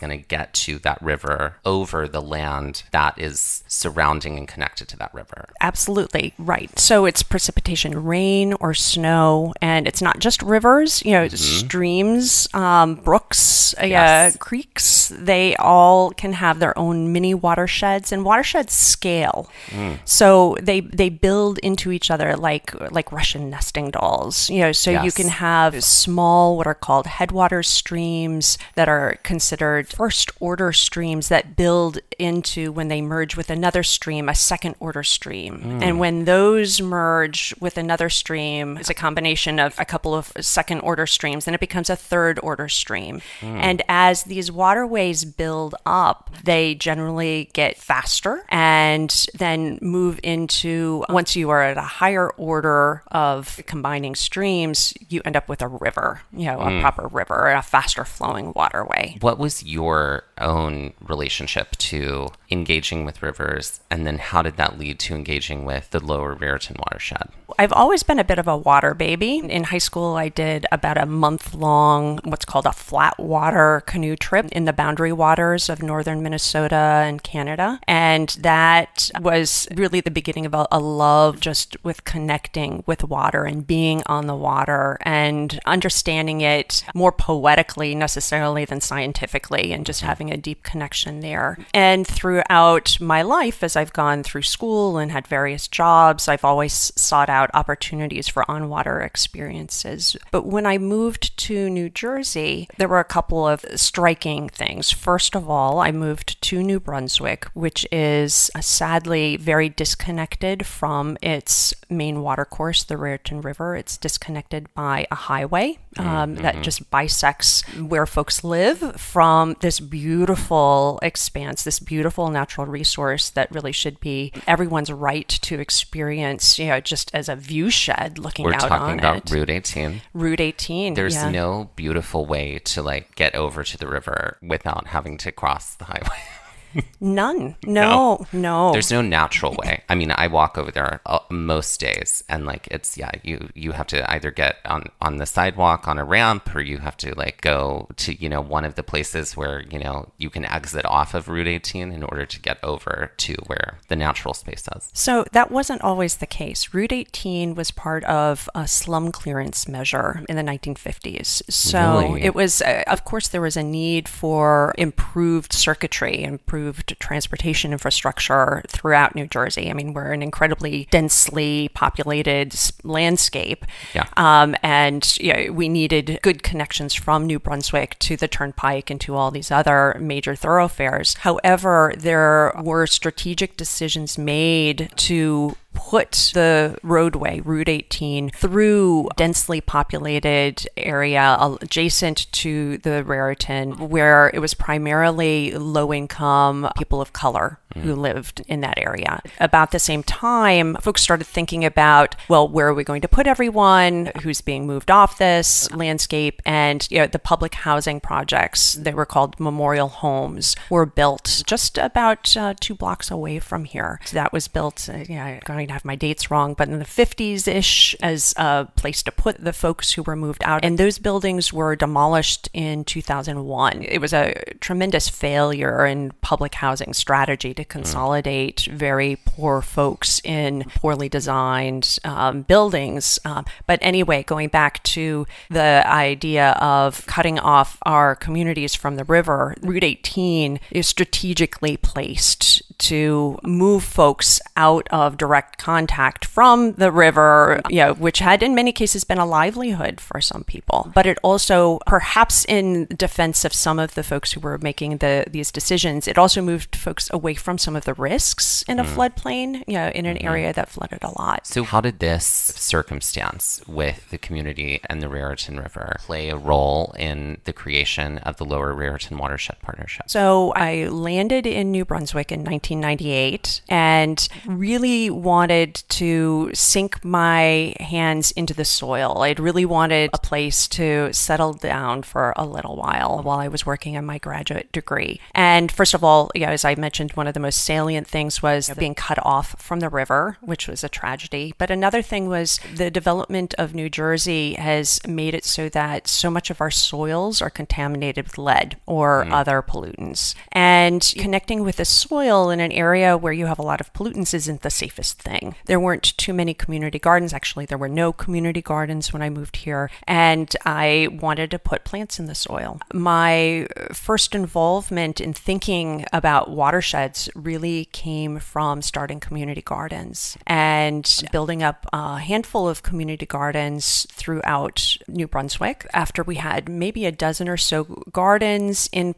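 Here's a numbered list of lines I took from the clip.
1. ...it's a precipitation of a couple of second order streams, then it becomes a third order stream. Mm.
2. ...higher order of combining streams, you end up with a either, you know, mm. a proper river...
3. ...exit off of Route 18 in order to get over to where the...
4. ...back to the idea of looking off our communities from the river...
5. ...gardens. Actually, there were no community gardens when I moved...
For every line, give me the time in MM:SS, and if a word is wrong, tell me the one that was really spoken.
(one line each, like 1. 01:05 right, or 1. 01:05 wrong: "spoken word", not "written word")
1. 00:38 wrong: "combination", not "precipitation"
2. 00:51 wrong: "river", not "either"
3. 02:30 right
4. 03:54 wrong: "cutting", not "looking"
5. 05:06 right.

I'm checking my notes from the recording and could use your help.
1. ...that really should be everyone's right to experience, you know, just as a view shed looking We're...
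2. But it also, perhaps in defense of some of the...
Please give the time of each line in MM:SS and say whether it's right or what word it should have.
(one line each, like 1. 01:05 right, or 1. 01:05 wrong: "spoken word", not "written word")
1. 02:03 right
2. 04:10 right.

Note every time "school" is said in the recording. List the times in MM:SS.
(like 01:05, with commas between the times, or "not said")
01:09, 01:34.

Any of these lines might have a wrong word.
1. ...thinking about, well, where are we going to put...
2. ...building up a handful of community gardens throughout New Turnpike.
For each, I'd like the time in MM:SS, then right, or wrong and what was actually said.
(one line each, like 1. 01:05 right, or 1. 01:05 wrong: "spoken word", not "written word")
1. 03:21 right
2. 05:21 wrong: "Brunswick", not "Turnpike".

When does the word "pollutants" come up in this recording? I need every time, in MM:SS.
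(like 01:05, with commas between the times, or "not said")
04:59, 05:03.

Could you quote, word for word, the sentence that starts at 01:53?
It's disconnected by a highway um, mm -hmm.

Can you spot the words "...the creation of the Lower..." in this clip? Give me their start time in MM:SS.
04:27.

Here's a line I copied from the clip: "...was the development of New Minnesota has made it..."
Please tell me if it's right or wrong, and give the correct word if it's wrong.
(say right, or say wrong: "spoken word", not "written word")
wrong: "Jersey", not "Minnesota".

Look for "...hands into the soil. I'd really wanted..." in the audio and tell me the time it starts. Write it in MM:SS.
04:37.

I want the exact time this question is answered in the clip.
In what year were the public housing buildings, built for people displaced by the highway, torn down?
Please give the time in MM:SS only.
03:42.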